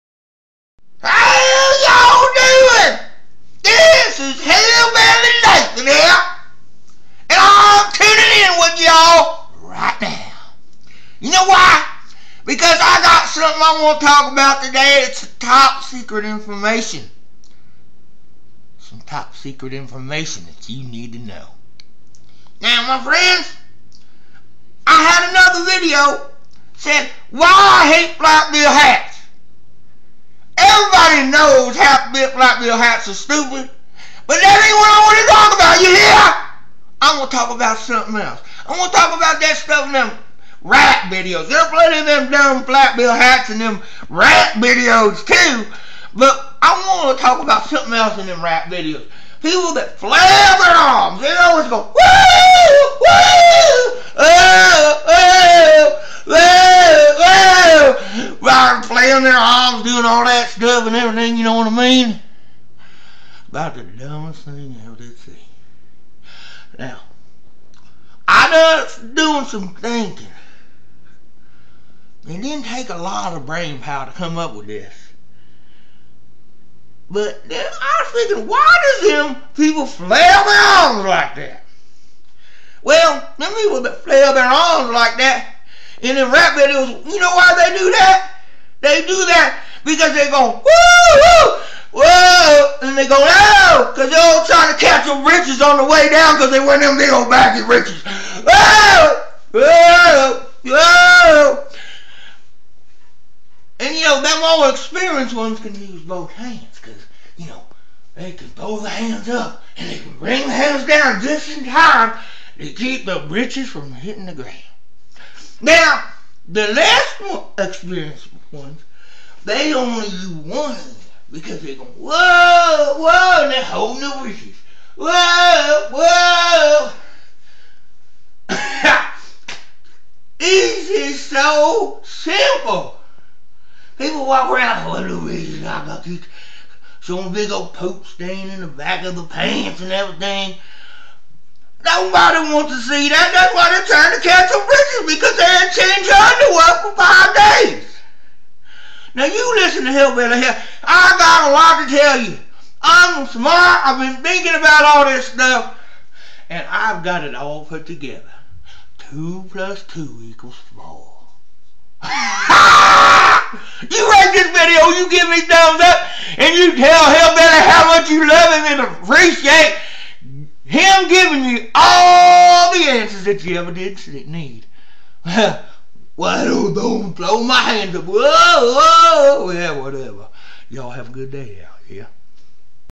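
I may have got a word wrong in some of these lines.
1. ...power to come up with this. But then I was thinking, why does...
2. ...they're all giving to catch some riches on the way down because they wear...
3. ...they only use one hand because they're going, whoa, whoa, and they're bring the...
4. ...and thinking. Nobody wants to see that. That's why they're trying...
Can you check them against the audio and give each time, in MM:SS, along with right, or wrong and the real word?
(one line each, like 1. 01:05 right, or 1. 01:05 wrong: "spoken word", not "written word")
1. 01:13 right
2. 01:34 wrong: "trying", not "giving"
3. 01:59 wrong: "holding", not "bring"
4. 02:19 wrong: "everything", not "thinking".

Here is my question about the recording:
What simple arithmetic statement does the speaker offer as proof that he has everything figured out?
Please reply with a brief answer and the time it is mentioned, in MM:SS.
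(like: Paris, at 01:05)
Two plus two equals four, at 02:38.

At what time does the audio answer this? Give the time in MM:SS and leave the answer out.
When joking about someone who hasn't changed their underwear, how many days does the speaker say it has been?
02:26.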